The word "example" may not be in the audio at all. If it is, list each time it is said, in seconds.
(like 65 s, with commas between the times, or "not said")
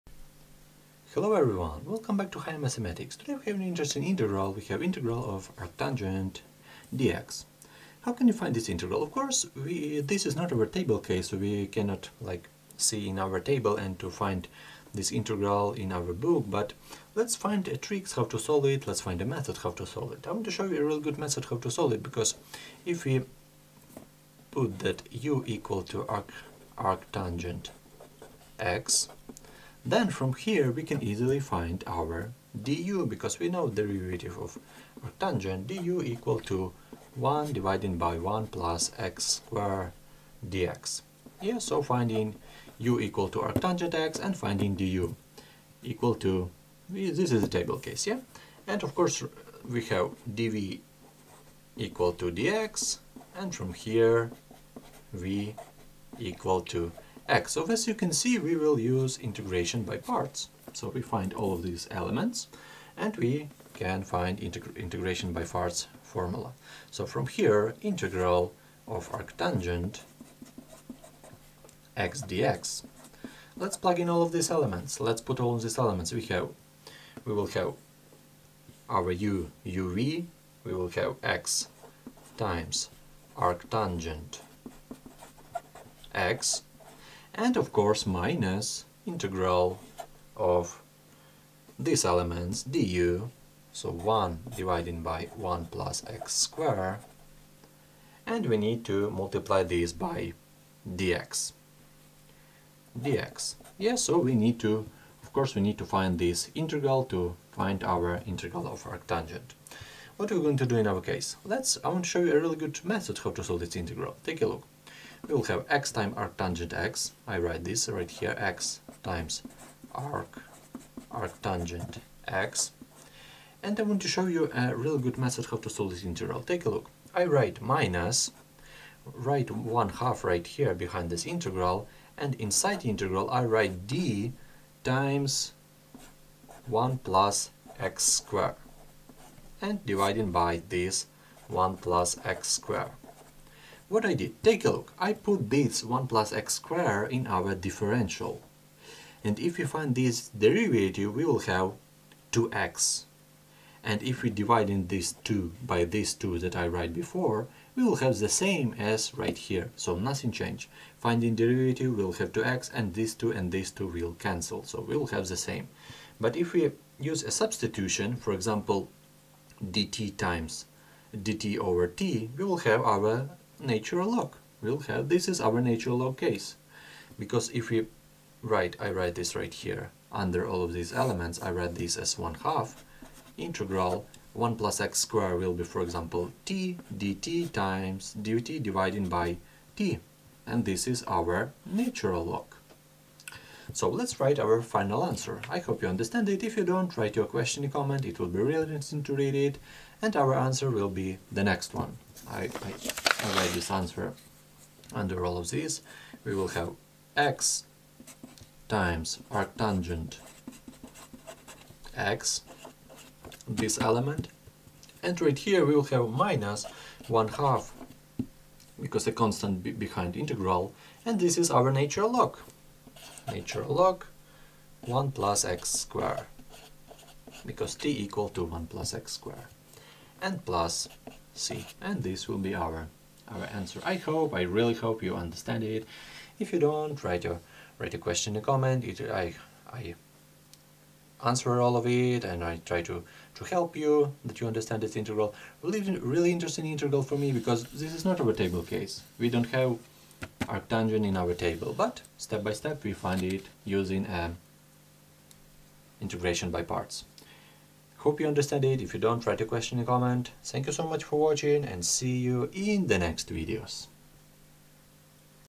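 168 s, 185 s.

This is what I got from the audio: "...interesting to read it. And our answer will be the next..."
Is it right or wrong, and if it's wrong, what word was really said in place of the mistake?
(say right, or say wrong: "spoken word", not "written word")
right.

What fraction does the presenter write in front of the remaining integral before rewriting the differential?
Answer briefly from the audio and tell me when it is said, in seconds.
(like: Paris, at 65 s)
one half, at 129 s.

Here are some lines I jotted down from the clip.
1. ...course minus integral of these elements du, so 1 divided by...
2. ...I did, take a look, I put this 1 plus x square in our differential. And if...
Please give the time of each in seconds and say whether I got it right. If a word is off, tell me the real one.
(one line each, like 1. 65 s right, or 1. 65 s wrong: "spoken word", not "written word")
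1. 87 s right
2. 144 s right.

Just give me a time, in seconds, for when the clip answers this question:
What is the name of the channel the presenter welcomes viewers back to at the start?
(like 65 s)
2 s.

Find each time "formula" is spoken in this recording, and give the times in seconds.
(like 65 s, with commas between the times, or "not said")
66 s.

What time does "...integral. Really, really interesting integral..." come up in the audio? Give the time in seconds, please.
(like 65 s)
244 s.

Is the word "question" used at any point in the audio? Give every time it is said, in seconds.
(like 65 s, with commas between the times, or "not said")
197 s, 237 s, 259 s.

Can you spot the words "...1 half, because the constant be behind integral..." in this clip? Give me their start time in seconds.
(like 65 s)
217 s.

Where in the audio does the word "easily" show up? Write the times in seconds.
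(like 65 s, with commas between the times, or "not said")
31 s.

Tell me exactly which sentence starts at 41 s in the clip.
Yeah, so finding u equal to arctangent x and finding du equal to, this is the table case, yeah?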